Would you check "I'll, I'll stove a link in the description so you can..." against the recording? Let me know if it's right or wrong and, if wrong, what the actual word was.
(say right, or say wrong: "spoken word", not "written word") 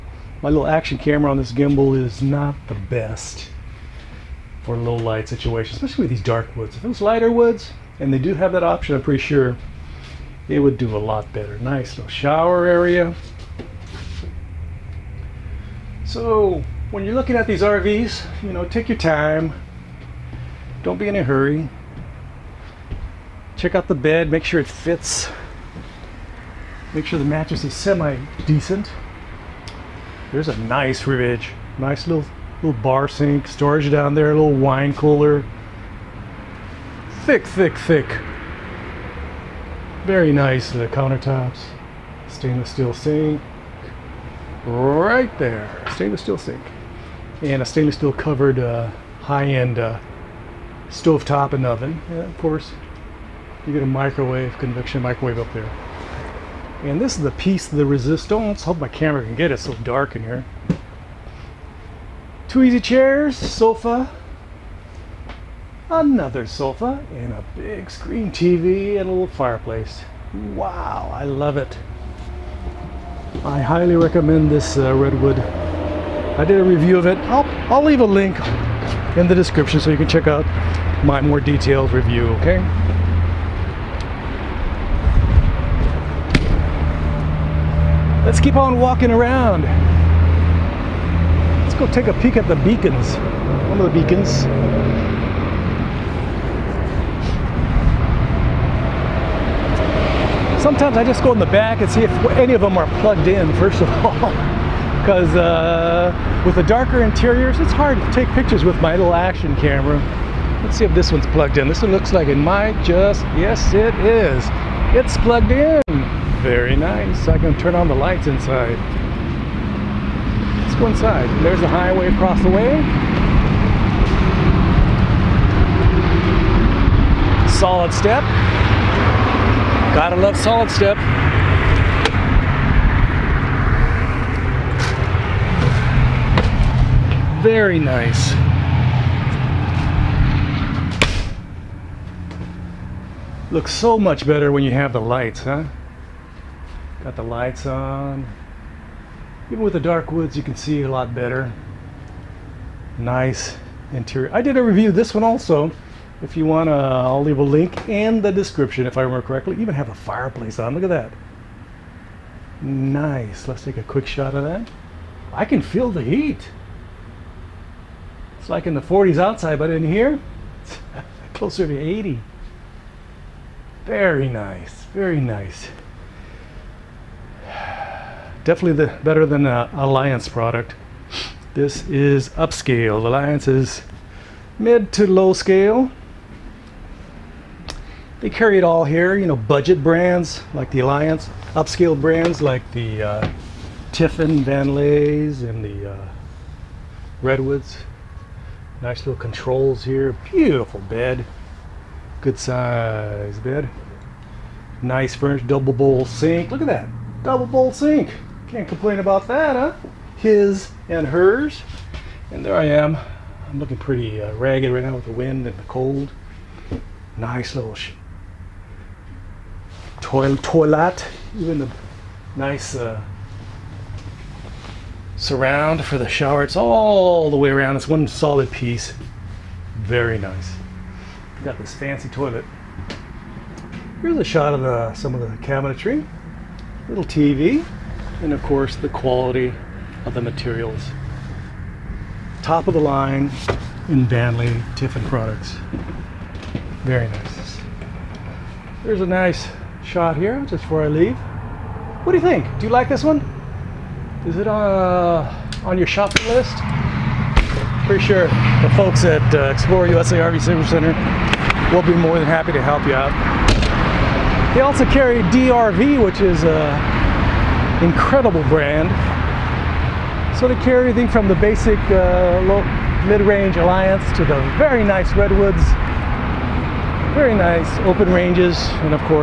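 wrong: "leave", not "stove".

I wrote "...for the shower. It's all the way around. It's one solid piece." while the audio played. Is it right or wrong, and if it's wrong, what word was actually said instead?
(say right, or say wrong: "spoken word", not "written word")
right.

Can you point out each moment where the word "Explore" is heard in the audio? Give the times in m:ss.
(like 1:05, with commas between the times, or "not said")
4:19.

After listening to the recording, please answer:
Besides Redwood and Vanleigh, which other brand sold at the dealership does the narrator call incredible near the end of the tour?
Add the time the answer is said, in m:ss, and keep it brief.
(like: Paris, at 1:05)
DRV, at 4:25.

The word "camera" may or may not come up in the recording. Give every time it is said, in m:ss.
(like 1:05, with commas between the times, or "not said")
0:00, 0:58, 1:49.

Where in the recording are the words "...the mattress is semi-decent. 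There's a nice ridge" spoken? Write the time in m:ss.
0:27.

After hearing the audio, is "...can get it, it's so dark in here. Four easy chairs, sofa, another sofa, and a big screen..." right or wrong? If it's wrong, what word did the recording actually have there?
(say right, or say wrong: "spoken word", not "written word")
wrong: "Two", not "Four".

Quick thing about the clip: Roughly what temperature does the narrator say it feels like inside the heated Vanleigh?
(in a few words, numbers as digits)
Close to 80.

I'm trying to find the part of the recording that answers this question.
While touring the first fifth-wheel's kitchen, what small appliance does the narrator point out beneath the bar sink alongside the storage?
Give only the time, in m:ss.
0:34.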